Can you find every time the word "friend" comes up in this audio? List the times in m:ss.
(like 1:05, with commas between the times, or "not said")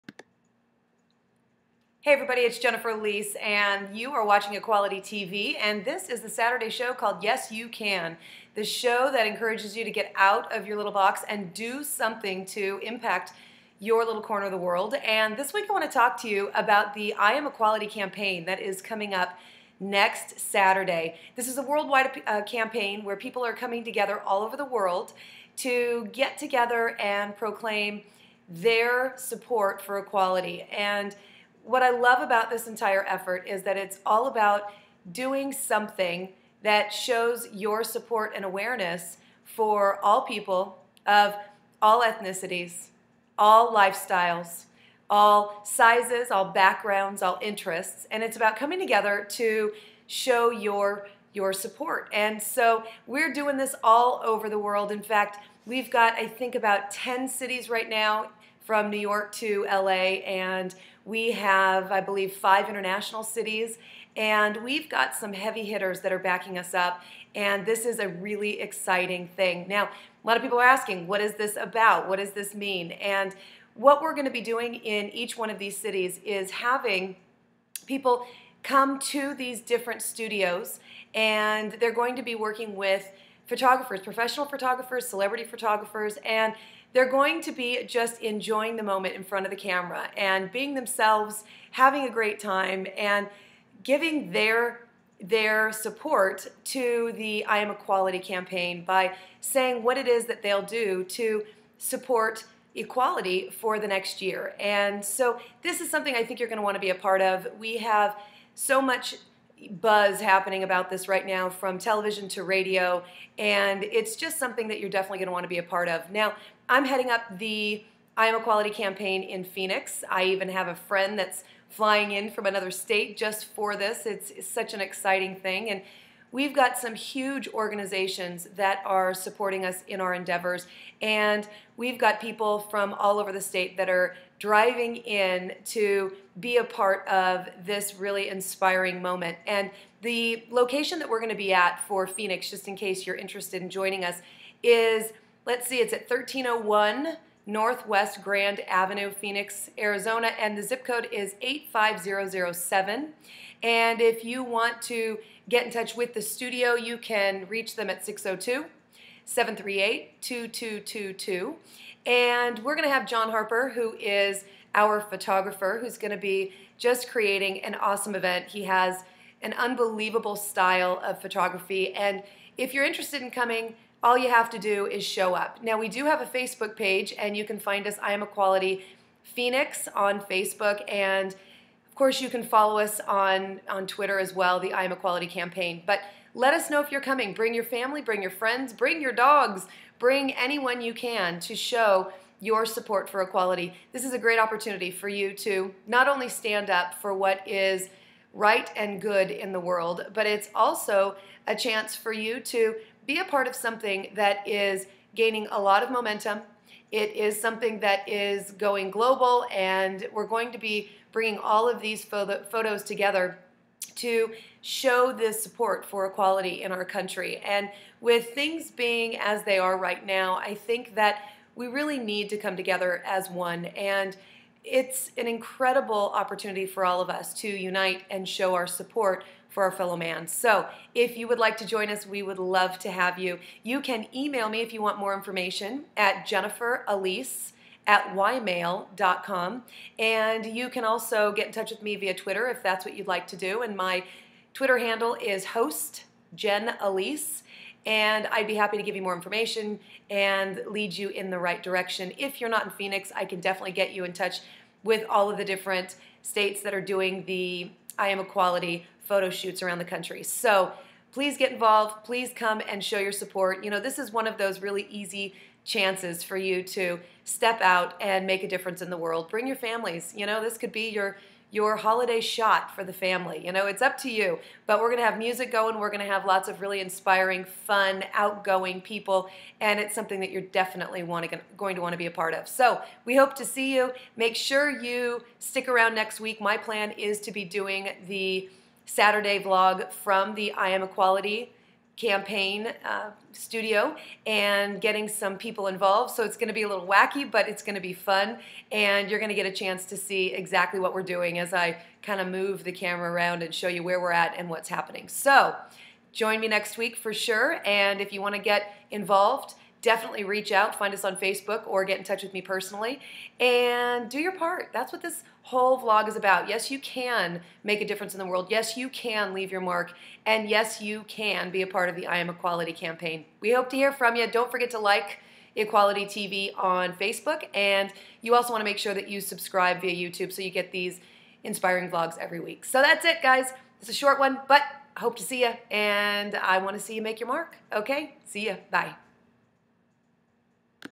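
2:00, 3:08.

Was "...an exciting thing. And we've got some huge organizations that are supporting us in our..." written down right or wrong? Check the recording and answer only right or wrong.
right.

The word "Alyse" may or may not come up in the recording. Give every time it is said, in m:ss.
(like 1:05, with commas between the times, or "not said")
0:02, 3:56, 4:06.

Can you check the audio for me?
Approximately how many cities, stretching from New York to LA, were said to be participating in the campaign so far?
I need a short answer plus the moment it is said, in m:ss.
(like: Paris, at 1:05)
10, at 0:56.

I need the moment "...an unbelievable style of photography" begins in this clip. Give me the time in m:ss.
2:49.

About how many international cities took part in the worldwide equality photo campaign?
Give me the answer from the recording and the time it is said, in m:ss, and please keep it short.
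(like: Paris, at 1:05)
5, at 1:02.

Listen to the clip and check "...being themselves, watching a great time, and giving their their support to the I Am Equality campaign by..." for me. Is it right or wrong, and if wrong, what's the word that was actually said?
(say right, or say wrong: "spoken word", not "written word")
wrong: "having", not "watching".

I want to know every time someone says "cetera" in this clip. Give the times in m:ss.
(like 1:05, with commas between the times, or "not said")
not said.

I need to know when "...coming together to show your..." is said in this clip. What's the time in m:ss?
0:48.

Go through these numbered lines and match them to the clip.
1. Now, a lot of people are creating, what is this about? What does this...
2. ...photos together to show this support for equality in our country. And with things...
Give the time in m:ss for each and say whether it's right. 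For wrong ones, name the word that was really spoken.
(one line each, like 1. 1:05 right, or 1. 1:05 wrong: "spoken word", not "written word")
1. 1:09 wrong: "asking", not "creating"
2. 3:32 right.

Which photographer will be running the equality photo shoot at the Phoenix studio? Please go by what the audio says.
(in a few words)
John Harper.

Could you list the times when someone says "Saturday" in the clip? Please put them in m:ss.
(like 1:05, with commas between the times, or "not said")
0:06, 0:20, 4:48.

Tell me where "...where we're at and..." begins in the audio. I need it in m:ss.
5:03.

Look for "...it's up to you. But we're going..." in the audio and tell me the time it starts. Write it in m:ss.
4:33.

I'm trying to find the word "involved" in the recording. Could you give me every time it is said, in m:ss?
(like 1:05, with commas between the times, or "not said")
4:21, 4:55, 5:08.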